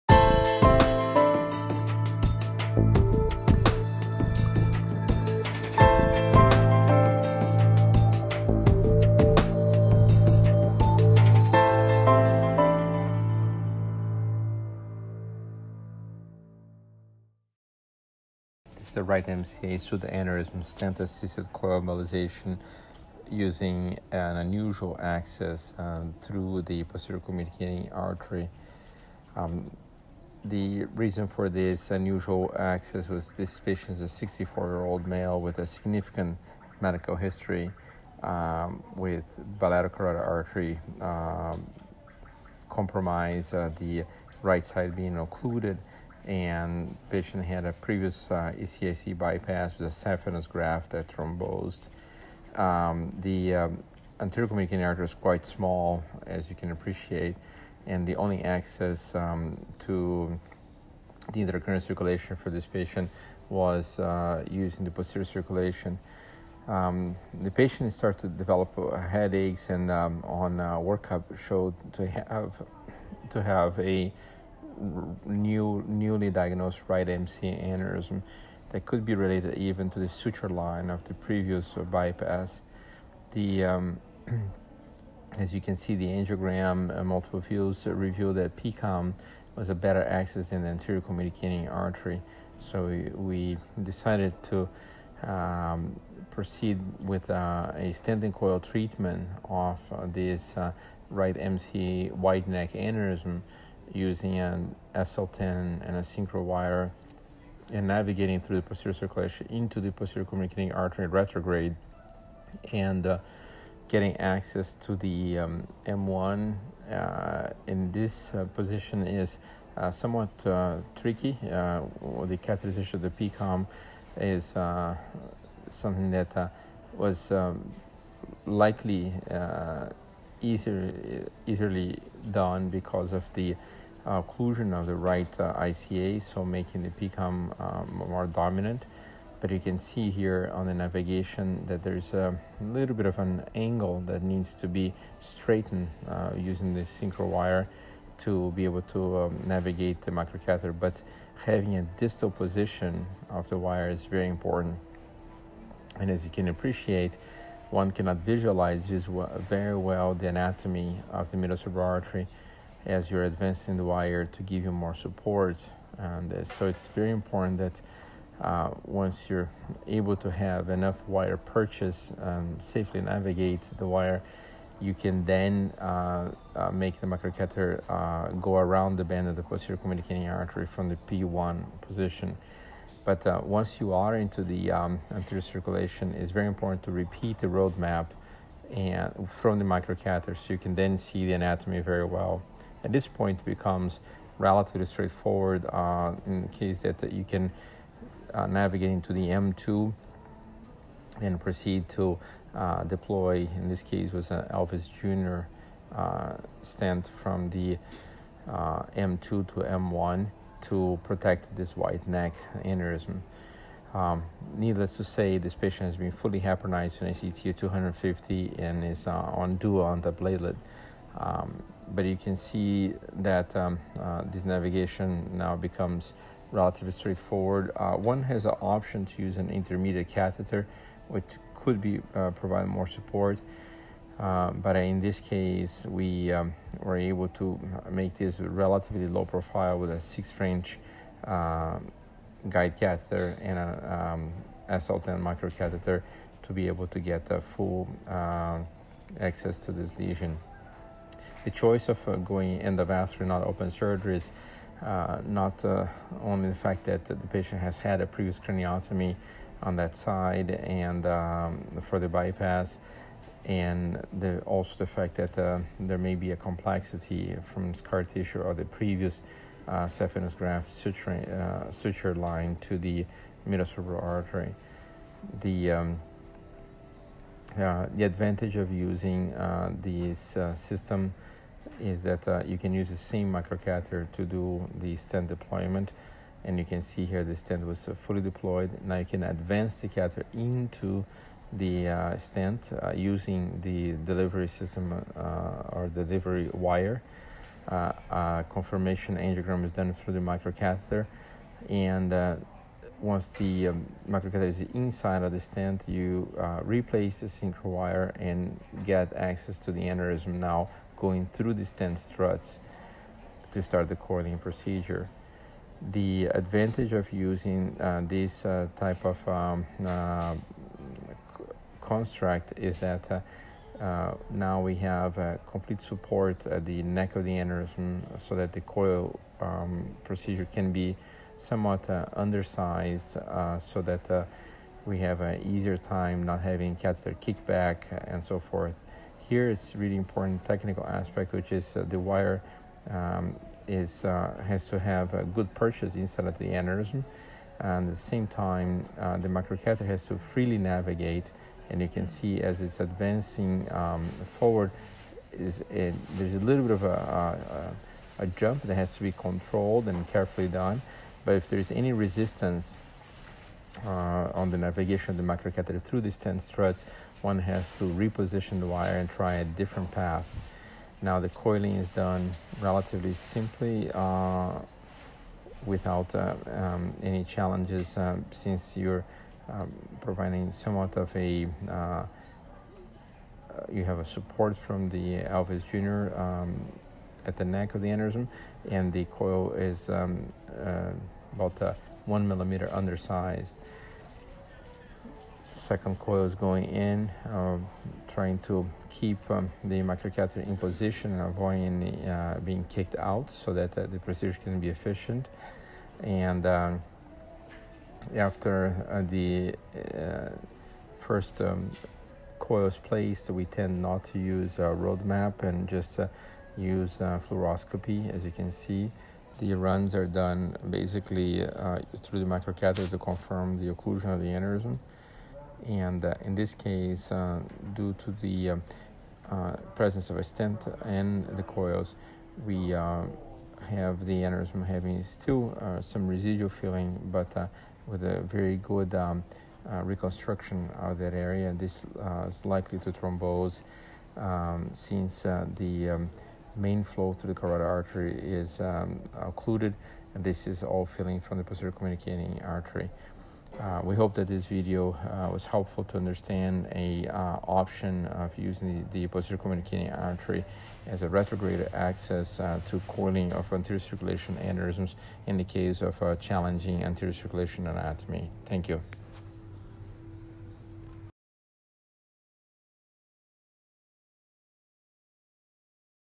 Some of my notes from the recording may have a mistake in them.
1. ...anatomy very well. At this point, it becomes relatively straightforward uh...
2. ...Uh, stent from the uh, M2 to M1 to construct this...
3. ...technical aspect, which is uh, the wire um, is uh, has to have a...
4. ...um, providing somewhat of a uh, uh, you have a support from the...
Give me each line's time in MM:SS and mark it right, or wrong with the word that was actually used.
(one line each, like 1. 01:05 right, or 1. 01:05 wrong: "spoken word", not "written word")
1. 03:11 right
2. 03:25 wrong: "protect", not "construct"
3. 05:40 right
4. 06:19 right.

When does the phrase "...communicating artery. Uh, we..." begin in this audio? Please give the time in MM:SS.
07:31.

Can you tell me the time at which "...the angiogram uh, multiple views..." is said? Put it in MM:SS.
01:25.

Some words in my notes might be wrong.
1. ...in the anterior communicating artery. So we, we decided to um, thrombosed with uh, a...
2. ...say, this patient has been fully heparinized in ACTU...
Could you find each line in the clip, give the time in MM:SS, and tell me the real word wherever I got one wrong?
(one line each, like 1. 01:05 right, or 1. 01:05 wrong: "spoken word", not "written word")
1. 01:30 wrong: "proceed", not "thrombosed"
2. 03:35 right.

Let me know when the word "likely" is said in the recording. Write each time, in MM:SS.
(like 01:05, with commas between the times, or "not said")
02:08, 07:22.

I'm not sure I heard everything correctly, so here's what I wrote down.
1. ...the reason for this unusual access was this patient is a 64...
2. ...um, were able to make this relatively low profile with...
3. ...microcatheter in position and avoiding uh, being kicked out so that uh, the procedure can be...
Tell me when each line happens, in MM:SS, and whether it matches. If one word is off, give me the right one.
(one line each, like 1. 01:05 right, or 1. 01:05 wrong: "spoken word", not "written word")
1. 00:30 right
2. 03:56 right
3. 06:39 right.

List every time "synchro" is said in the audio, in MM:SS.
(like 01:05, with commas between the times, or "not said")
01:46, 02:26, 05:07.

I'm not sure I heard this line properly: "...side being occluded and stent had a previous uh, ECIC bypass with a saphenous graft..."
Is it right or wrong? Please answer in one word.
wrong.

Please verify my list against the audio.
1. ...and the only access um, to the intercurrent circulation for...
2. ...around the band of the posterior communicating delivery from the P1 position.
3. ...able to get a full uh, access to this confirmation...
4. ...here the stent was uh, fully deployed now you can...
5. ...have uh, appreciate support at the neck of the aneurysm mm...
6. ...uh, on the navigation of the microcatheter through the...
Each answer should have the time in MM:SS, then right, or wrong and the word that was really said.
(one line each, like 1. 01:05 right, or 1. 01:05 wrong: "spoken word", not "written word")
1. 00:57 right
2. 02:58 wrong: "artery", not "delivery"
3. 04:06 wrong: "lesion", not "confirmation"
4. 04:47 right
5. 05:24 wrong: "complete", not "appreciate"
6. 06:03 right.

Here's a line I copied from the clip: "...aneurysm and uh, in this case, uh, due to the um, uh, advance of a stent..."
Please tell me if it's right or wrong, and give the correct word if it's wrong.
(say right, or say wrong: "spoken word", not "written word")
wrong: "presence", not "advance".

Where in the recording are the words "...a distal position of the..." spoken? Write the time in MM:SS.
02:31.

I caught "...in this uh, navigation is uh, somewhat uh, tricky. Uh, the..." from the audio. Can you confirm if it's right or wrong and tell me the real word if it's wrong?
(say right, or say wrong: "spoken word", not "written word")
wrong: "position", not "navigation".